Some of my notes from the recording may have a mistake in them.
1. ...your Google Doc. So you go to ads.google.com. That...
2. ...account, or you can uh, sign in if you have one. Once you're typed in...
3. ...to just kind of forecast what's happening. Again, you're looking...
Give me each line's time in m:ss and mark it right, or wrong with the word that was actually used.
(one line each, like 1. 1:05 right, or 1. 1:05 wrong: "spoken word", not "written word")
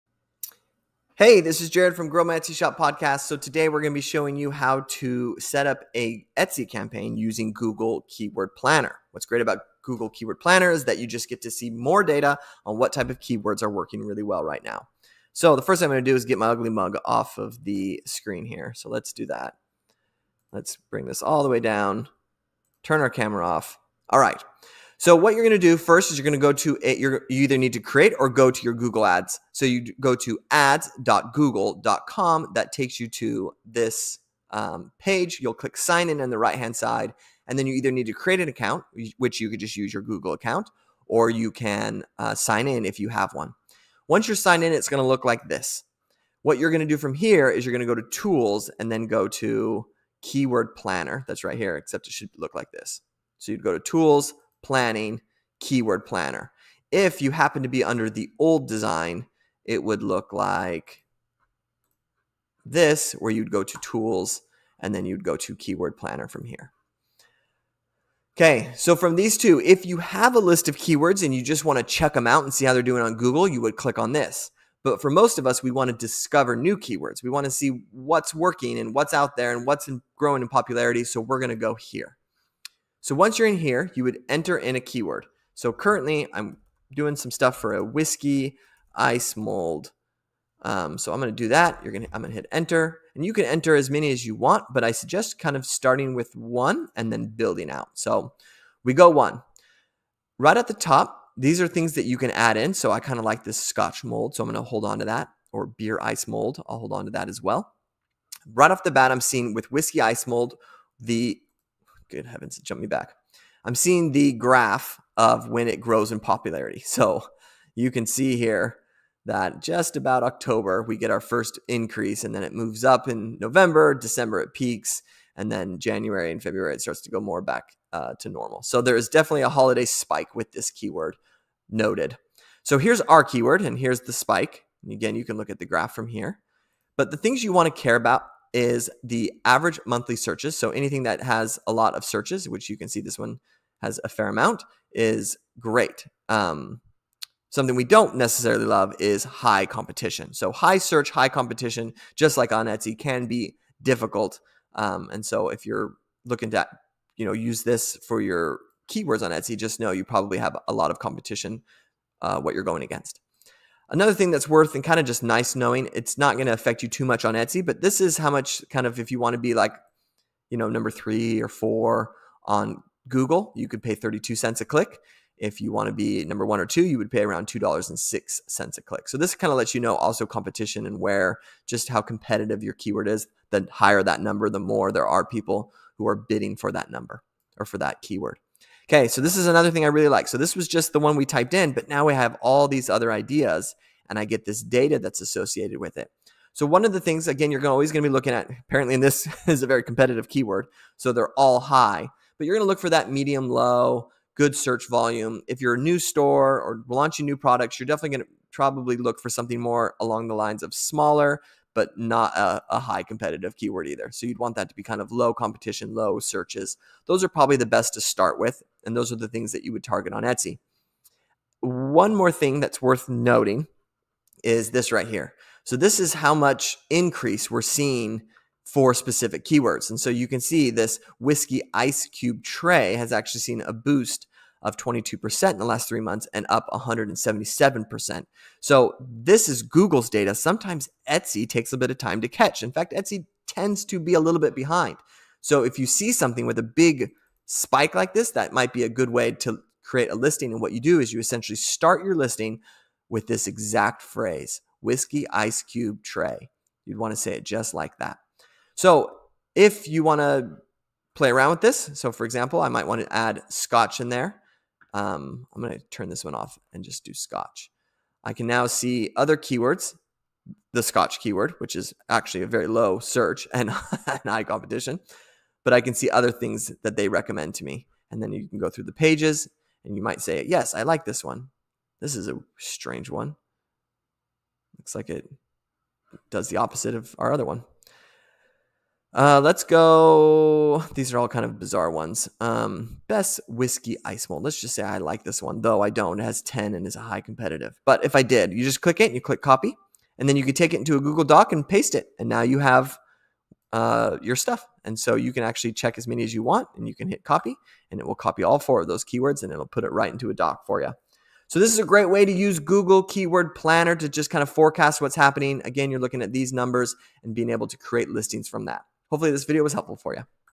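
1. 0:28 wrong: "Ads", not "Doc"
2. 0:40 wrong: "signed", not "typed"
3. 5:13 right.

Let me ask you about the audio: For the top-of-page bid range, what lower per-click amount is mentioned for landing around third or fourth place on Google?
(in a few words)
32 cents.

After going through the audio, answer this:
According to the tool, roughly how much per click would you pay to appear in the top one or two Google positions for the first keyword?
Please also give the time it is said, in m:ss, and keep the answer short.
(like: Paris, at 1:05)
$2.06, at 2:57.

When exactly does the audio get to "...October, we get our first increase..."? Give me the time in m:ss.
2:00.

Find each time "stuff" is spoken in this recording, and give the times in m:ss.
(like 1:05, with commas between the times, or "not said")
1:27, 5:04.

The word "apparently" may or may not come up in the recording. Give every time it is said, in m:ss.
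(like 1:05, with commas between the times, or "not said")
3:18.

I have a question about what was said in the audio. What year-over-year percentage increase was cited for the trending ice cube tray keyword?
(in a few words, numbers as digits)
177%.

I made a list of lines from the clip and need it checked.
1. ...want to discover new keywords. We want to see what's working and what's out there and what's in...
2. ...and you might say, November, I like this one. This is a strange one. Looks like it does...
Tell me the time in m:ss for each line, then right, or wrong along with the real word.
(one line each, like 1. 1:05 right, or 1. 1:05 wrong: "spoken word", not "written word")
1. 1:15 right
2. 4:39 wrong: "Yes", not "November".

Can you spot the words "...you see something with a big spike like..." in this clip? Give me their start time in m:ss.
4:05.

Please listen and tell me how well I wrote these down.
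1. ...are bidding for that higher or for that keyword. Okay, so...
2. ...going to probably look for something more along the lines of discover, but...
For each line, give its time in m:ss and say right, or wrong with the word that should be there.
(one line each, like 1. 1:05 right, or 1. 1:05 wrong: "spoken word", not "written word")
1. 3:06 wrong: "number", not "higher"
2. 3:28 wrong: "smaller", not "discover".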